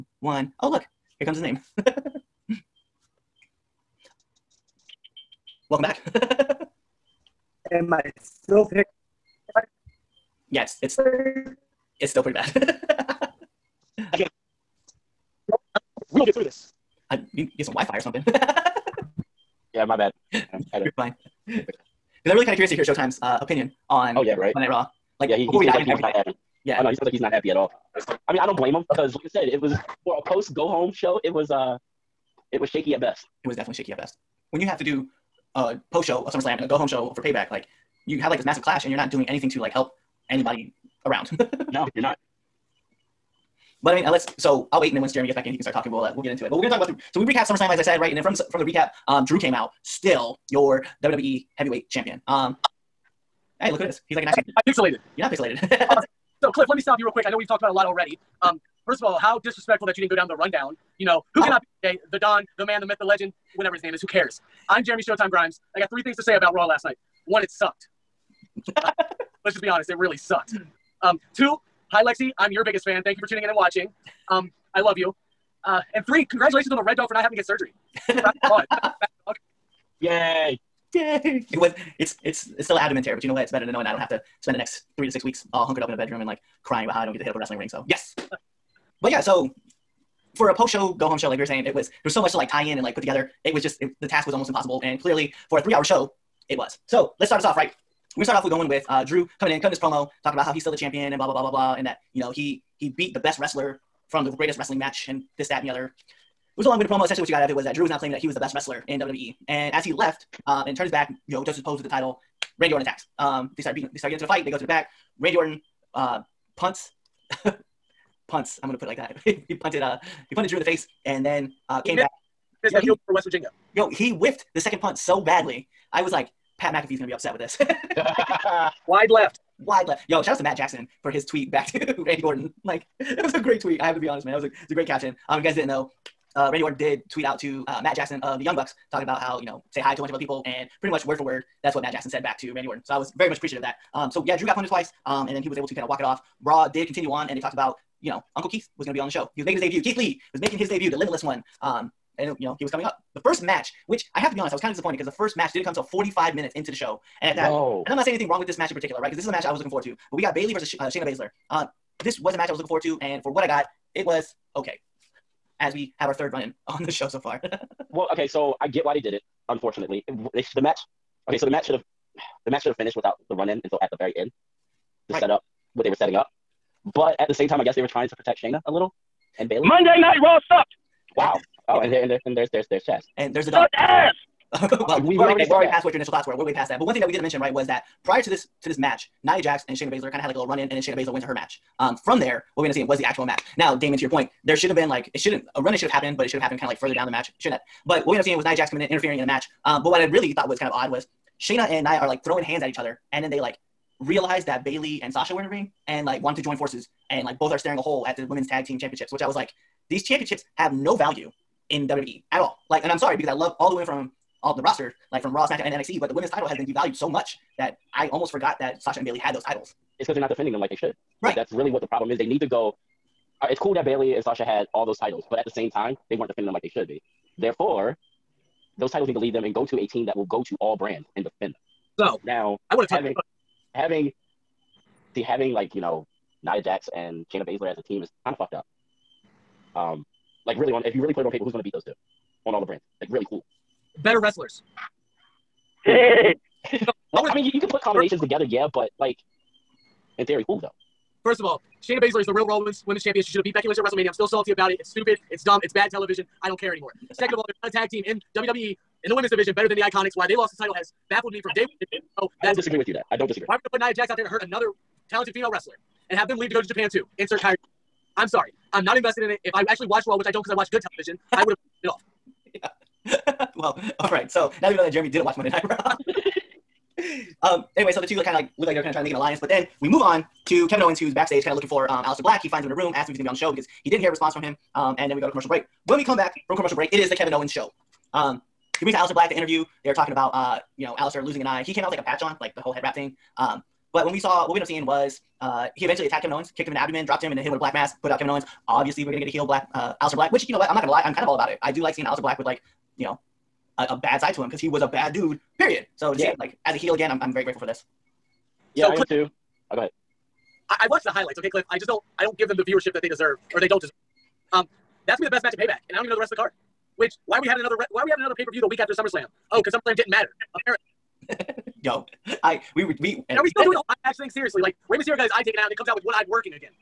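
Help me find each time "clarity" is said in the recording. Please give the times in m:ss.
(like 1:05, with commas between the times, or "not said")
not said.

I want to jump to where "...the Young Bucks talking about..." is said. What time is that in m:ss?
2:18.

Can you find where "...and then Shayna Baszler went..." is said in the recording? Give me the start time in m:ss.
3:10.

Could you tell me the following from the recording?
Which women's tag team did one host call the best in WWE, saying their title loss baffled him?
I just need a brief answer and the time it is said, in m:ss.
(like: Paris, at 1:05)
The Iconics, at 4:19.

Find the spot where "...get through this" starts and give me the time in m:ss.
0:16.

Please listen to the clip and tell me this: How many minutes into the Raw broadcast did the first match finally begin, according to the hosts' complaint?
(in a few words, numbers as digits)
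45.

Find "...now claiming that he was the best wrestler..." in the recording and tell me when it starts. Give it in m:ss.
1:47.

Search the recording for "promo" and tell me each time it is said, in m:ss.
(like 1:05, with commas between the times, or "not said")
1:39, 1:46.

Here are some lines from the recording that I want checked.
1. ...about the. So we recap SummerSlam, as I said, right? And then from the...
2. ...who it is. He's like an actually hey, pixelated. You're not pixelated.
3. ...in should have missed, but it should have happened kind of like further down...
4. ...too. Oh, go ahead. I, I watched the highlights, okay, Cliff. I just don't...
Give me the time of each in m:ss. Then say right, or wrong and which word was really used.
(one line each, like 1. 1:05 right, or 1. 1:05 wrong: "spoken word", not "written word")
1. 0:46 right
2. 0:53 right
3. 3:15 wrong: "happened", not "missed"
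4. 5:09 right.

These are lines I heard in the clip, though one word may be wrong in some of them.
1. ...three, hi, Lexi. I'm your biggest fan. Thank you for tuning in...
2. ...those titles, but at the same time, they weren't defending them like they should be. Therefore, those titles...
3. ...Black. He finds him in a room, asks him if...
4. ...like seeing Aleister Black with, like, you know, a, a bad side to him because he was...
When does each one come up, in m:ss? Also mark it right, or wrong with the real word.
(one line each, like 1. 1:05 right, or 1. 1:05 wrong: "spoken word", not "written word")
1. 1:11 wrong: "two", not "three"
2. 3:44 right
3. 4:42 right
4. 5:01 right.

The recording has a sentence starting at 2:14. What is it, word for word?
That was a, a great caption.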